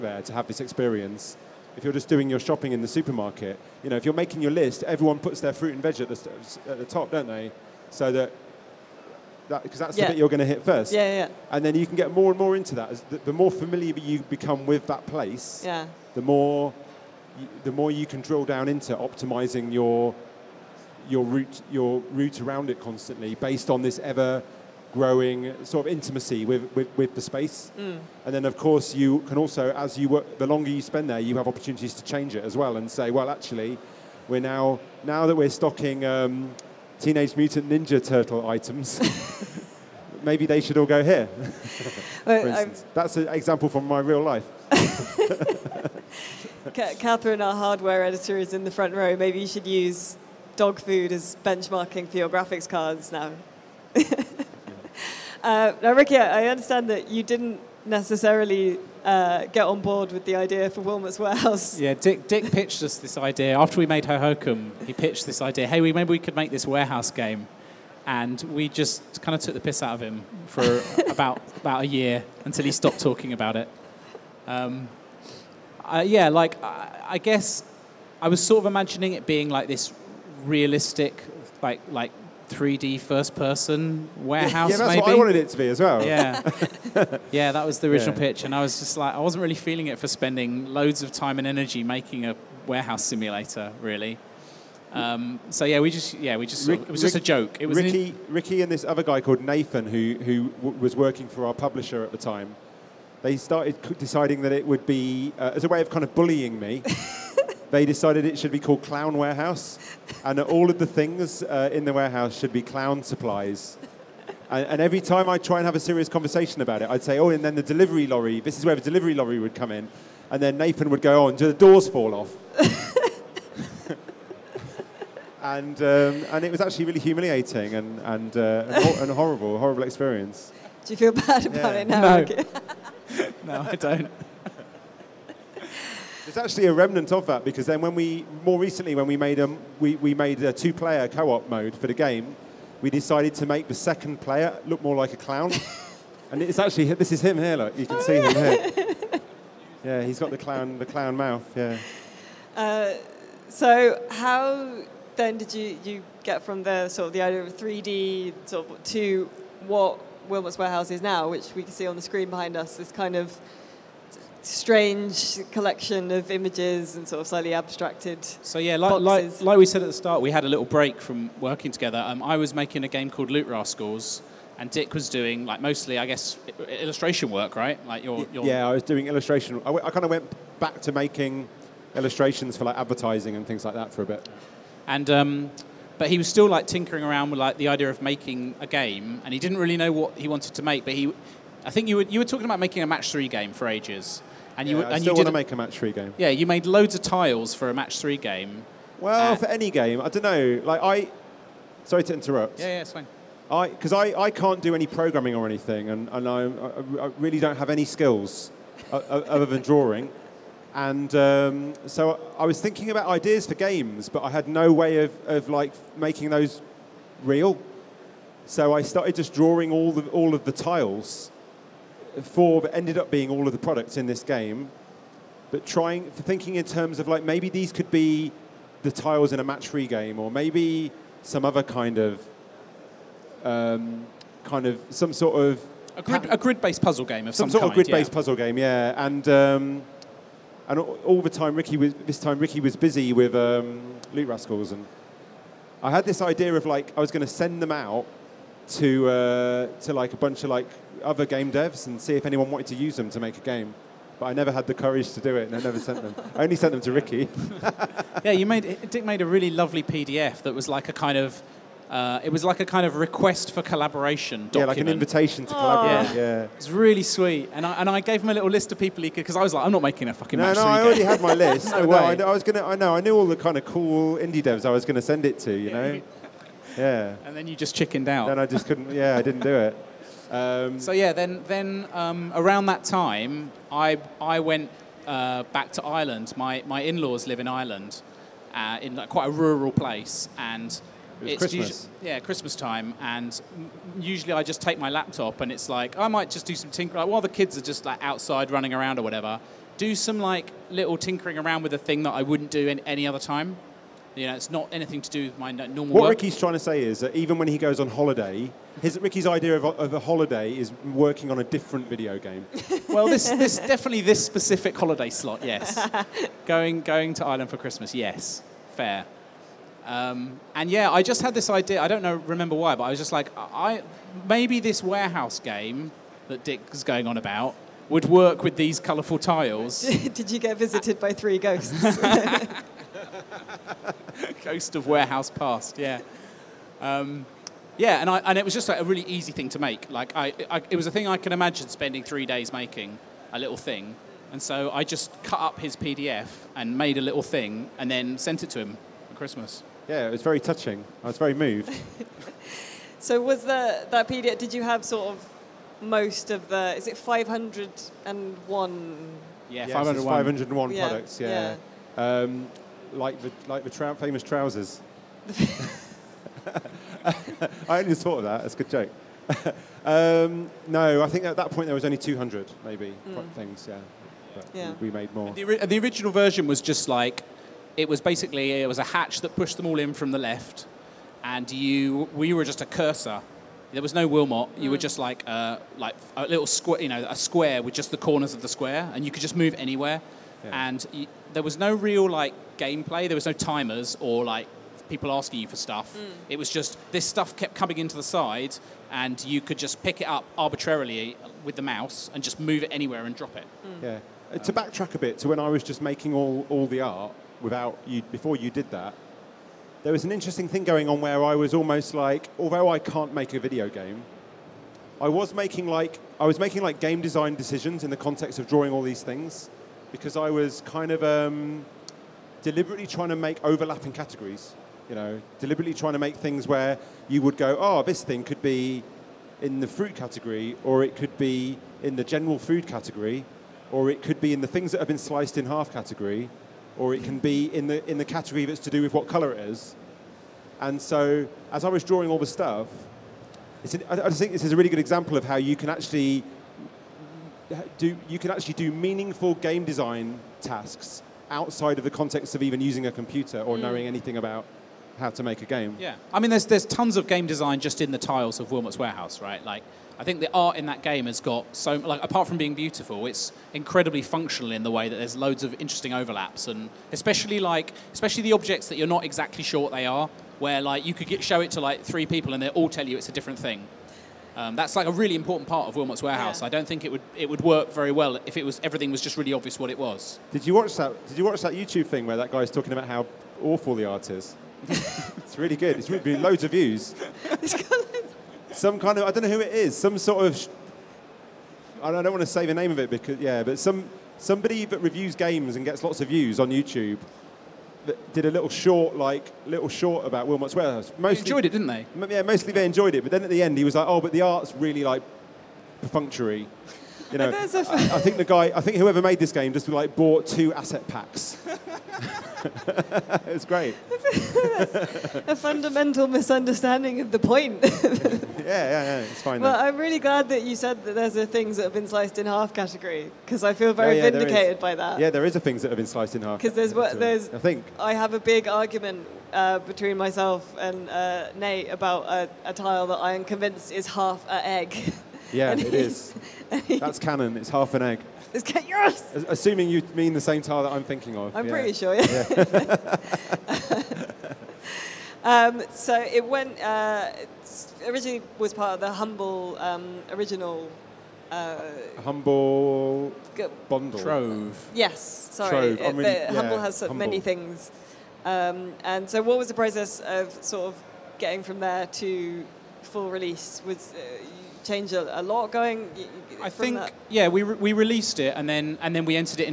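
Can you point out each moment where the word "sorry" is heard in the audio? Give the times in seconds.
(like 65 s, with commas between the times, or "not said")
201 s, 555 s.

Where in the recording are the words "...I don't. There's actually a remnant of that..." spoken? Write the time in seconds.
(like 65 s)
133 s.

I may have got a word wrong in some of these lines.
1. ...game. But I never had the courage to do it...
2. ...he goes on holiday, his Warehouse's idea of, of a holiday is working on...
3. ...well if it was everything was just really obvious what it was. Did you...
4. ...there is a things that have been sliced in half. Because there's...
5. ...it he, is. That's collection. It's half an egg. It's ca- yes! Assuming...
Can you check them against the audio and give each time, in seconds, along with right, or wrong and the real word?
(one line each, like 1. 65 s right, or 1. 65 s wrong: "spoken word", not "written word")
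1. 253 s right
2. 307 s wrong: "Ricky", not "Warehouse"
3. 477 s right
4. 525 s right
5. 535 s wrong: "canon", not "collection".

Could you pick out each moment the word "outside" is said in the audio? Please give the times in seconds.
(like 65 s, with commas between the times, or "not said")
298 s, 451 s.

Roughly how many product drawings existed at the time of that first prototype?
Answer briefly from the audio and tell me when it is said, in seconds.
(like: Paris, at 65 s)
200, at 371 s.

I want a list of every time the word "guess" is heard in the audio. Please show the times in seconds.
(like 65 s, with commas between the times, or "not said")
77 s, 176 s.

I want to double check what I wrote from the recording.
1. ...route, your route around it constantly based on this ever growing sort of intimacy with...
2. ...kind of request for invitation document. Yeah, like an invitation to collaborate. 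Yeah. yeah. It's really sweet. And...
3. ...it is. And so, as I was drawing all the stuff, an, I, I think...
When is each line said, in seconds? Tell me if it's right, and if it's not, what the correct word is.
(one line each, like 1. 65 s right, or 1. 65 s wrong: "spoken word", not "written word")
1. 21 s right
2. 262 s wrong: "collaboration", not "invitation"
3. 439 s right.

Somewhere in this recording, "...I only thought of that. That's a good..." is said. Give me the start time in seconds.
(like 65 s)
367 s.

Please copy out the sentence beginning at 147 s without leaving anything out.
Look, you can oh, see yeah.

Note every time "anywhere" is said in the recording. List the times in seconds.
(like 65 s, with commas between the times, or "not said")
389 s, 402 s.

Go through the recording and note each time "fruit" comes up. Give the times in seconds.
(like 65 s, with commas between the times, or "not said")
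5 s, 429 s.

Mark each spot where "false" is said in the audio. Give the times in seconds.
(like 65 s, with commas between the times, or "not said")
not said.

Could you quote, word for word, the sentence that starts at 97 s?
It was Ricky in- Ricky and this other guy called Nathan who who w- was working for our publisher at the time.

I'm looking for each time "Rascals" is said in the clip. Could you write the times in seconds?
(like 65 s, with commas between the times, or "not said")
173 s, 244 s.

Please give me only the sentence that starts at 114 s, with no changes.
And, and, every time I try and have a serious conversation about it, I'd say, "Oh, and then the delivery lorry.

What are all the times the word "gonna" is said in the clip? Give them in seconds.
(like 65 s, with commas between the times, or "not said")
272 s.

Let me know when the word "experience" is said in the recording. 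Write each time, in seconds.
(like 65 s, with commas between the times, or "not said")
0 s, 129 s.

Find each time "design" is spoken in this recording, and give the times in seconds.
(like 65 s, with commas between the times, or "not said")
417 s, 449 s, 457 s.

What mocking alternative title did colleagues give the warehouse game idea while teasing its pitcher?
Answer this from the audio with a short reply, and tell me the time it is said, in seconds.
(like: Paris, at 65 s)
Clown Warehouse, at 108 s.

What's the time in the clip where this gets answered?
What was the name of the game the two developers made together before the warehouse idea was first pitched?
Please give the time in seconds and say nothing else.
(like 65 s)
64 s.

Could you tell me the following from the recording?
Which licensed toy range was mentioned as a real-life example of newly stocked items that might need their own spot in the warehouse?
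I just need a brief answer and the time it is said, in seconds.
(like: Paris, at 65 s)
Teenage Mutant Ninja Turtle, at 36 s.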